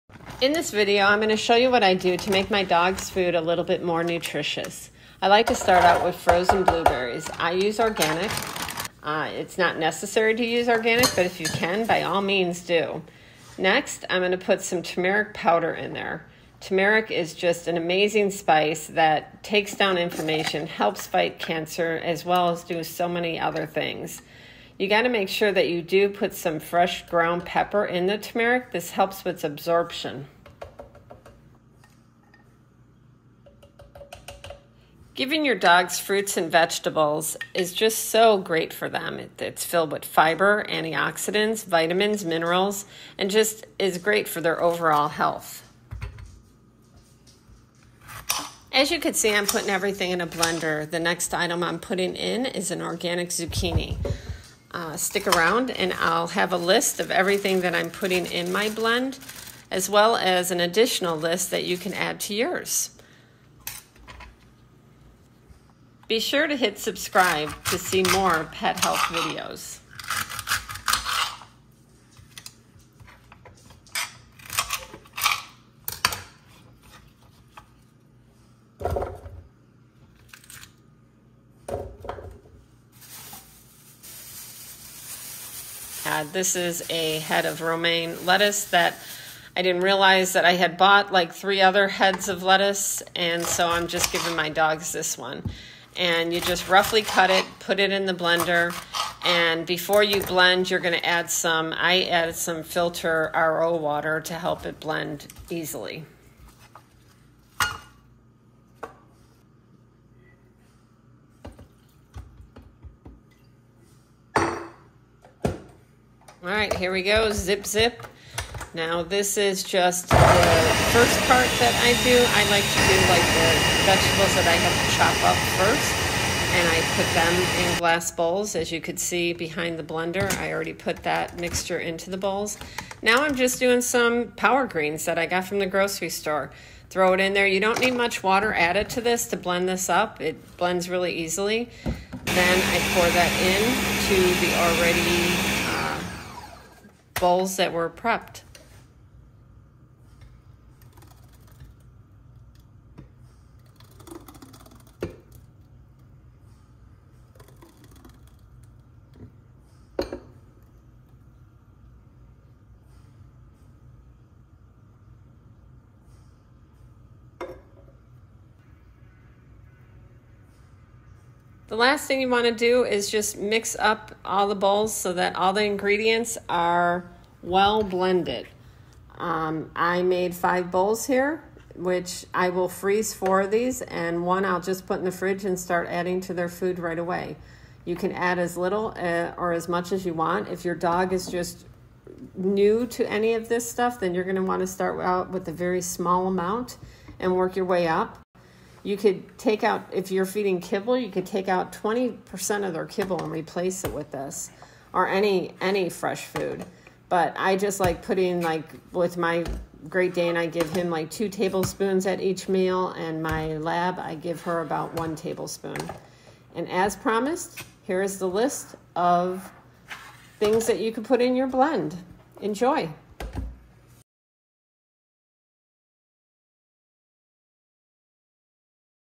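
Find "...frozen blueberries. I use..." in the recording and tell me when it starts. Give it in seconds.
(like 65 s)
6 s.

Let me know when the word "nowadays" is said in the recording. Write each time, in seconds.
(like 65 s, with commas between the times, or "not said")
not said.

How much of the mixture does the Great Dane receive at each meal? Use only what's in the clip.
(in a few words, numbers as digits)
2 tablespoons.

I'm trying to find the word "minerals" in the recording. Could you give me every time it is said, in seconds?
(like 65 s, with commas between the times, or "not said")
42 s.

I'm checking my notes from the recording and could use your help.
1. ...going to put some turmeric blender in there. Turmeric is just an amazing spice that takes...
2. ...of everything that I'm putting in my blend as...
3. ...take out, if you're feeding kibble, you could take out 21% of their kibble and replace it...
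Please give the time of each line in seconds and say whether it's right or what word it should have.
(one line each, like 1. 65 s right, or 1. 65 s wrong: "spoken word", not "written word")
1. 14 s wrong: "powder", not "blender"
2. 56 s right
3. 199 s wrong: "20", not "21".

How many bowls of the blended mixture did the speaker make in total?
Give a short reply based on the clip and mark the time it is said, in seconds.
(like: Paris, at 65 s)
5, at 180 s.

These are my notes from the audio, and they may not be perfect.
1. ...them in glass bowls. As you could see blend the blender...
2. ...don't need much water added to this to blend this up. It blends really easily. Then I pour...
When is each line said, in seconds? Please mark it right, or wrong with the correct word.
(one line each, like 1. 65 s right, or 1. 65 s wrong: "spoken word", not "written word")
1. 127 s wrong: "behind", not "blend"
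2. 137 s right.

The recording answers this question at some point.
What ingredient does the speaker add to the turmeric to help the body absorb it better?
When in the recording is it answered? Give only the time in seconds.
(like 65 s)
26 s.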